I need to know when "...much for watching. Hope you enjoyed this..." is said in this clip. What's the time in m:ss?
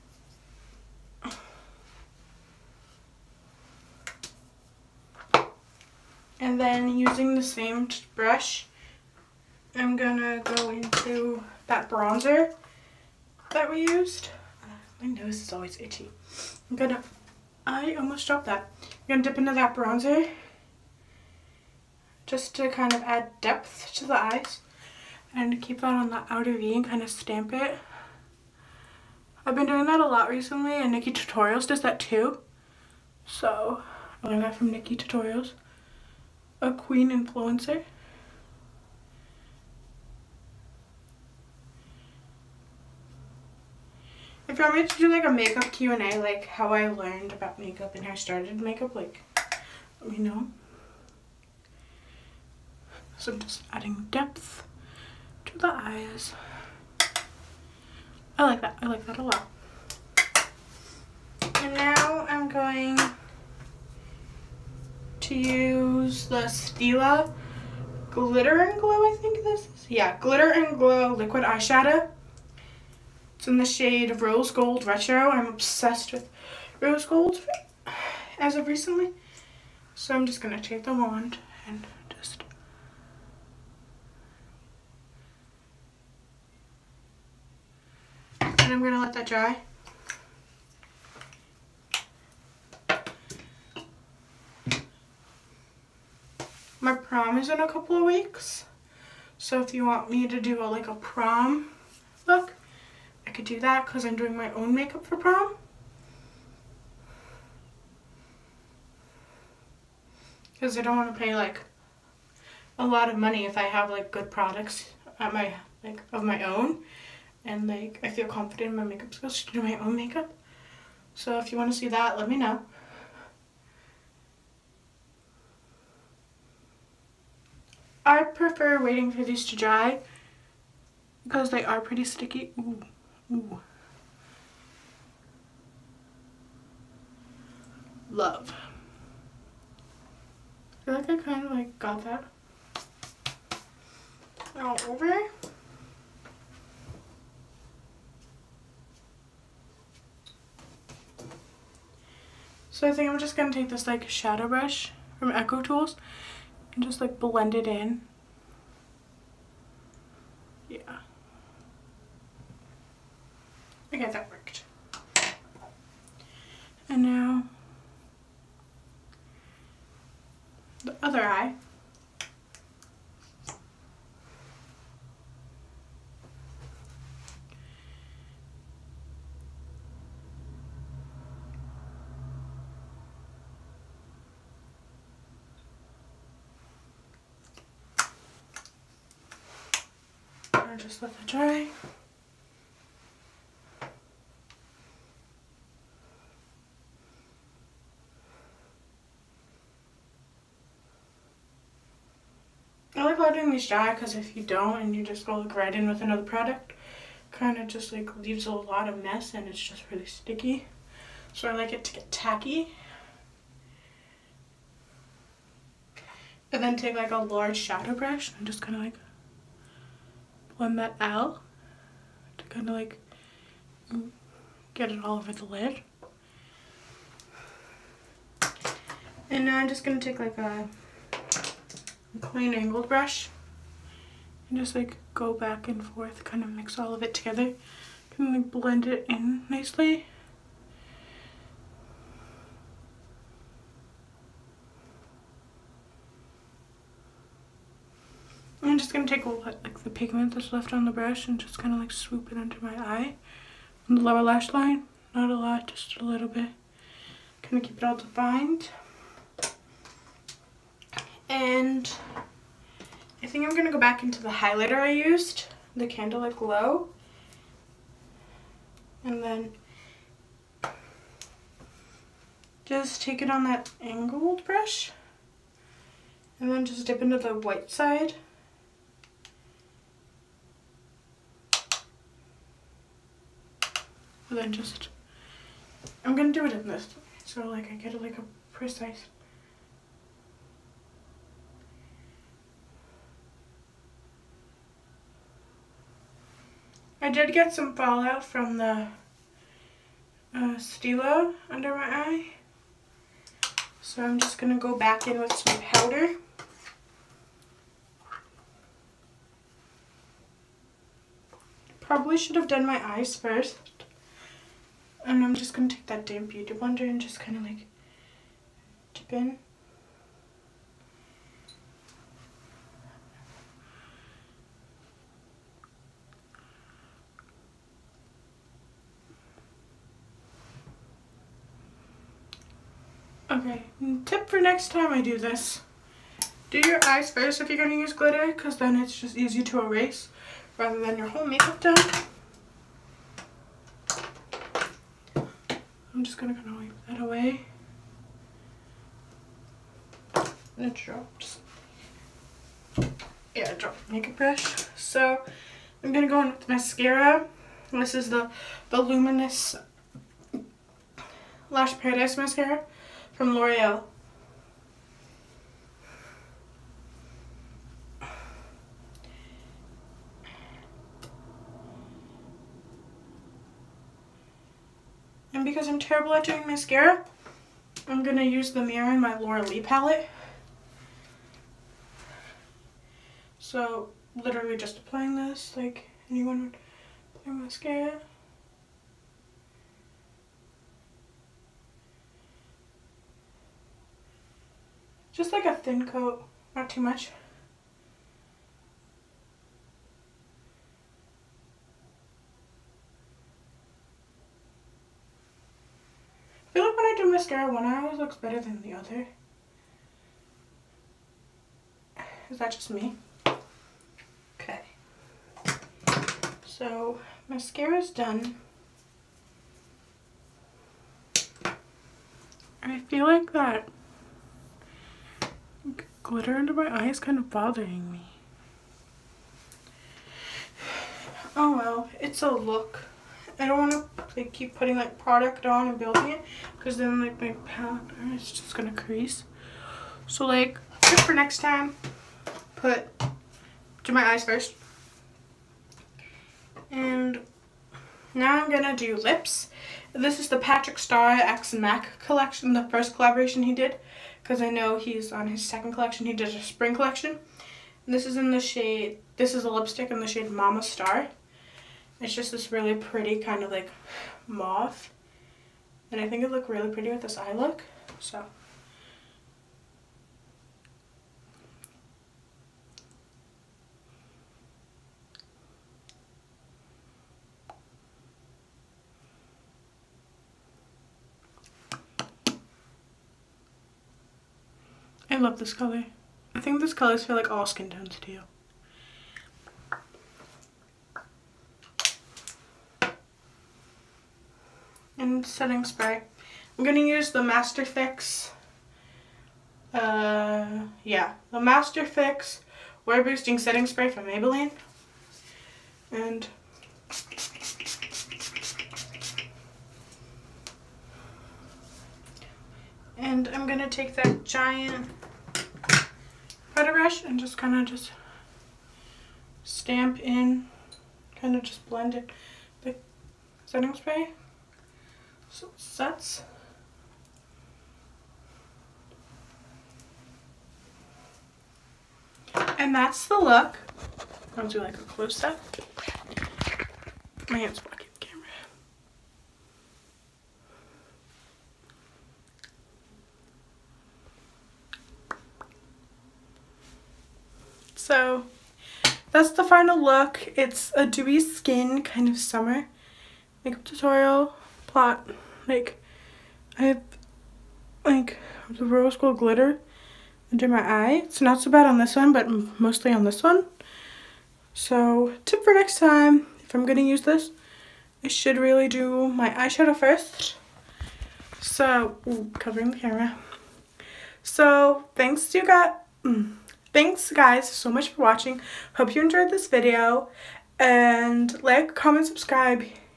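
9:37.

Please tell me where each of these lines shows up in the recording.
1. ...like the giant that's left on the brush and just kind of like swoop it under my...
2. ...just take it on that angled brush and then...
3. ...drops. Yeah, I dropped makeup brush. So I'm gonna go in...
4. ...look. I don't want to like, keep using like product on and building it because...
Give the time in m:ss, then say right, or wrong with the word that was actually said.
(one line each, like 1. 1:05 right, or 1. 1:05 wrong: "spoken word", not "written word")
1. 4:09 wrong: "pigment", not "giant"
2. 4:32 right
3. 5:50 right
4. 7:12 wrong: "putting", not "using".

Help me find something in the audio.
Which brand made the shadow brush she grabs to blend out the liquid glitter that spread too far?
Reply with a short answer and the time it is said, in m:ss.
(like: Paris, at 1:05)
EcoTools, at 2:35.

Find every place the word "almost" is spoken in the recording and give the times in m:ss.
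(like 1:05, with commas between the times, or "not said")
0:17.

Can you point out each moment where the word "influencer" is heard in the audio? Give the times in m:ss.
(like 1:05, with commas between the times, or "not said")
0:37.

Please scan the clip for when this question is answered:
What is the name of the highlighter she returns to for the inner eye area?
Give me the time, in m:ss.
4:25.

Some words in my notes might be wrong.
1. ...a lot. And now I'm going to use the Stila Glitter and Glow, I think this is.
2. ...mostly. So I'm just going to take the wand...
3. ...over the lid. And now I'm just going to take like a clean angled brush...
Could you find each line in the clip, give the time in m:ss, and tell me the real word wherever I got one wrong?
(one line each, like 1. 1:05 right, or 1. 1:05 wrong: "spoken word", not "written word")
1. 0:59 right
2. 1:18 wrong: "recently", not "mostly"
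3. 3:45 right.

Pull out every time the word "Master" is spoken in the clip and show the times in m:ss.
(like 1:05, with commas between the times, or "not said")
8:17, 8:21.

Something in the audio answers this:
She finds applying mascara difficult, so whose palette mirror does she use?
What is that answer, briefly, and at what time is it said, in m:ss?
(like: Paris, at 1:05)
Laura Lee, at 6:19.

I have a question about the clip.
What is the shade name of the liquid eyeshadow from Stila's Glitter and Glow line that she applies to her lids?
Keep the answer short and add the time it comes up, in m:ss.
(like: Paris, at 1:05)
Rose Gold Retro, at 1:14.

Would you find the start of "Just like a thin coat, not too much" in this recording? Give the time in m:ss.
6:35.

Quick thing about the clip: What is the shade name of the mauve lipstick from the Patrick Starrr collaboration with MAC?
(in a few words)
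Mama Star.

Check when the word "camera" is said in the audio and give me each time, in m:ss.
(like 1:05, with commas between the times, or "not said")
8:58, 9:32.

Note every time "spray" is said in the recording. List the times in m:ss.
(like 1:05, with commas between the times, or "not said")
8:15, 8:23, 8:43.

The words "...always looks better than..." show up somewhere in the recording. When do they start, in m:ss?
6:47.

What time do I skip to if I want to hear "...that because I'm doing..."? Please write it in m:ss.
1:43.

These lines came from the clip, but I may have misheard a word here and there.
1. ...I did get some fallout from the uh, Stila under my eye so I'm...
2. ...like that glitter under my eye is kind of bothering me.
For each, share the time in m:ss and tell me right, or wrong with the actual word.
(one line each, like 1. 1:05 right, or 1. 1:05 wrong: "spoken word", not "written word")
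1. 4:57 right
2. 7:03 right.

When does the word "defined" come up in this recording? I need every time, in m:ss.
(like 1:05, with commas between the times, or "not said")
4:17.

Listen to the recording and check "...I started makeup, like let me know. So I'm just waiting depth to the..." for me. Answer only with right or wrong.
wrong.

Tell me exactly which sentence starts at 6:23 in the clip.
So, literally just applying this like anyone would apply mascara.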